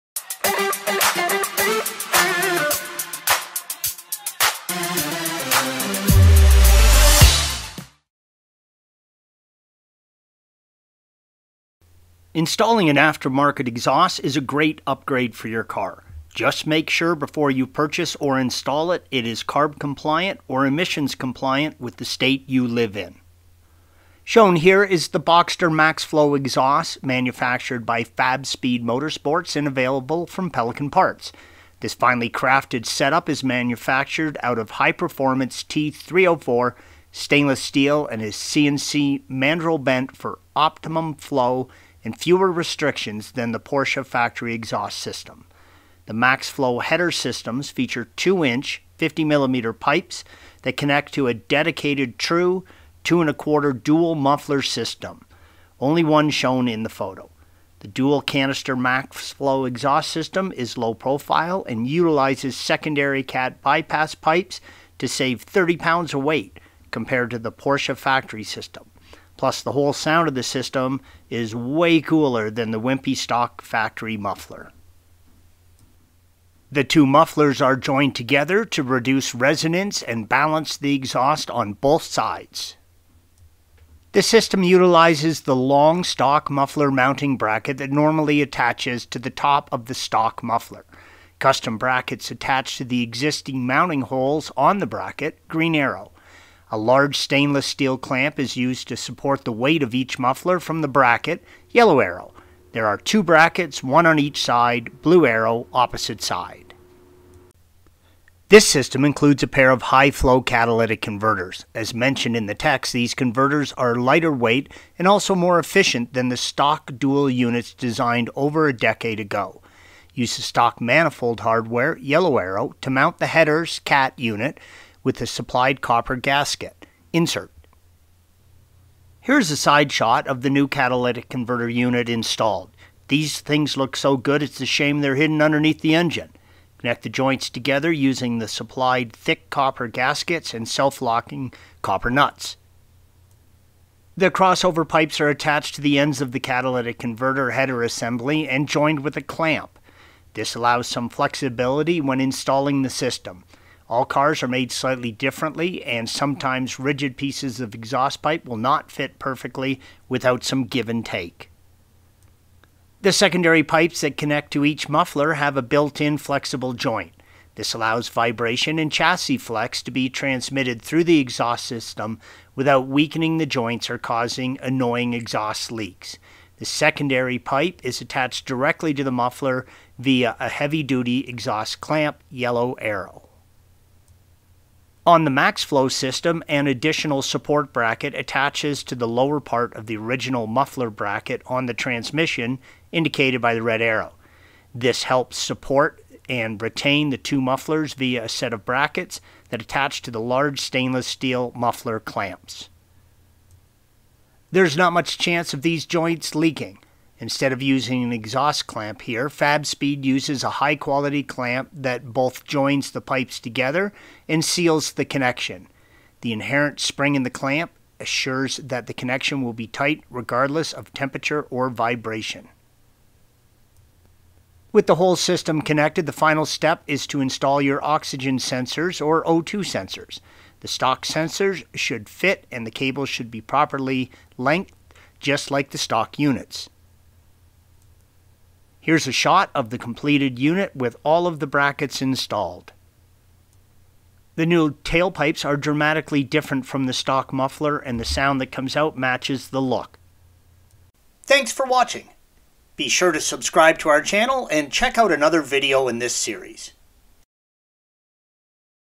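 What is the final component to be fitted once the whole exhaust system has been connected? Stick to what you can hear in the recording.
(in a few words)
Oxygen sensors.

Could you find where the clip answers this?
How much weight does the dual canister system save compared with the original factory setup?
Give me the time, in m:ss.
1:05.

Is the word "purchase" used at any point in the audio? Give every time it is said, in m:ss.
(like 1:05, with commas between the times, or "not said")
0:17.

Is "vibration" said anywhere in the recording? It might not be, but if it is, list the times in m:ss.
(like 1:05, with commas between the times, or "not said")
2:48, 3:41.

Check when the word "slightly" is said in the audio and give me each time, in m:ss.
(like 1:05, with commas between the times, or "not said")
2:34.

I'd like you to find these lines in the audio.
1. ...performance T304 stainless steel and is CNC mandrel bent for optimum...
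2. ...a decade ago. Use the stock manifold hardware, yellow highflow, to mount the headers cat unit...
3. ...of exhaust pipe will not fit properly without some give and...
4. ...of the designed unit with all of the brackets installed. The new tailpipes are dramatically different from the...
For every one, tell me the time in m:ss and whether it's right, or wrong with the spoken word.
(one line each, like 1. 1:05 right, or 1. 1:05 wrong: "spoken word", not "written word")
1. 0:34 right
2. 1:58 wrong: "arrow", not "highflow"
3. 2:37 wrong: "perfectly", not "properly"
4. 3:59 wrong: "completed", not "designed".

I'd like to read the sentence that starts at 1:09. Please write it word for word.
Plus, the whole sound of the system is way cooler than the wimpy stock factory muffler.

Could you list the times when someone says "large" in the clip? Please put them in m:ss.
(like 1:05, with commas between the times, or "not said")
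1:36, 3:20.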